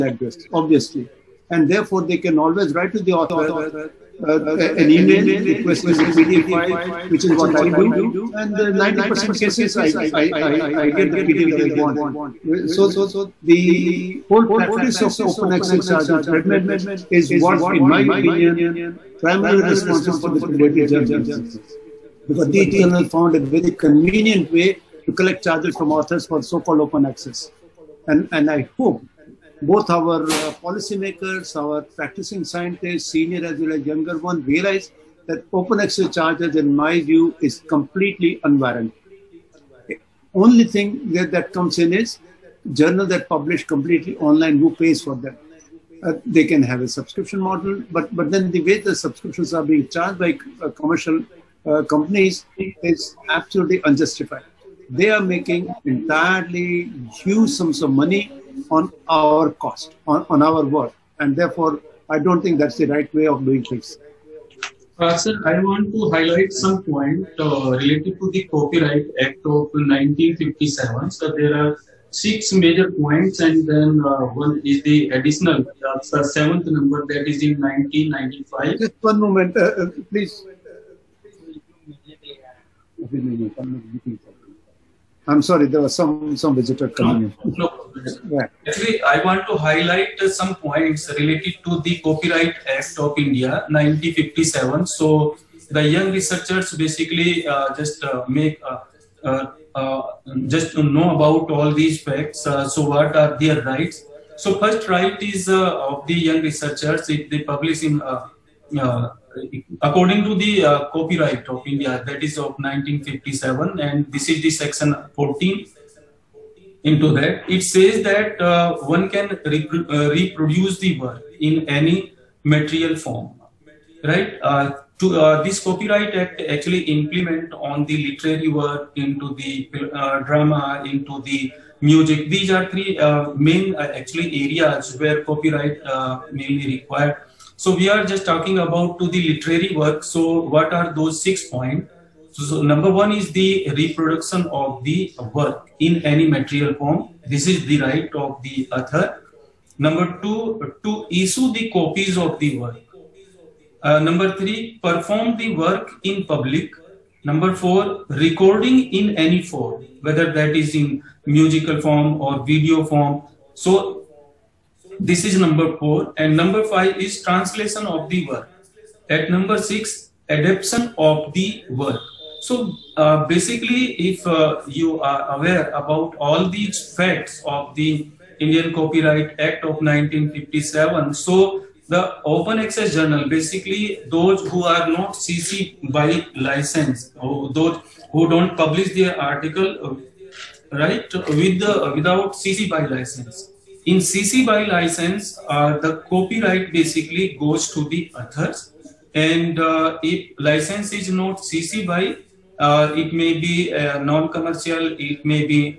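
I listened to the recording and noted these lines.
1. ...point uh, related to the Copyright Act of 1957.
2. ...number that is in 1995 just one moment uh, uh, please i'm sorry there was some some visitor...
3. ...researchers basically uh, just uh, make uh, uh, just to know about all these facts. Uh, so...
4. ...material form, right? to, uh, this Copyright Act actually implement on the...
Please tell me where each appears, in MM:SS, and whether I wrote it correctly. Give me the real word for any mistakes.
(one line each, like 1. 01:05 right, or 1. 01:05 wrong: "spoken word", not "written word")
1. 01:06 right
2. 01:16 right
3. 01:36 right
4. 02:02 right.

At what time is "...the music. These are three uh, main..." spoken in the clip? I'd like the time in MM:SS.
02:11.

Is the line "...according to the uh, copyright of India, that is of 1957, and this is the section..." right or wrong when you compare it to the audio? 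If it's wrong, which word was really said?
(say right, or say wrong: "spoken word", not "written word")
right.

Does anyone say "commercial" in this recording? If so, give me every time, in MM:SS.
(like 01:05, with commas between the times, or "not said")
00:50, 03:24.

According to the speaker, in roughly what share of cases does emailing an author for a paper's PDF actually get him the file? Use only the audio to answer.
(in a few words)
90%.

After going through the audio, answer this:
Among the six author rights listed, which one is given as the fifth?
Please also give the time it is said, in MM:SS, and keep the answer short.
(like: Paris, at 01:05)
Translation of the work, at 02:47.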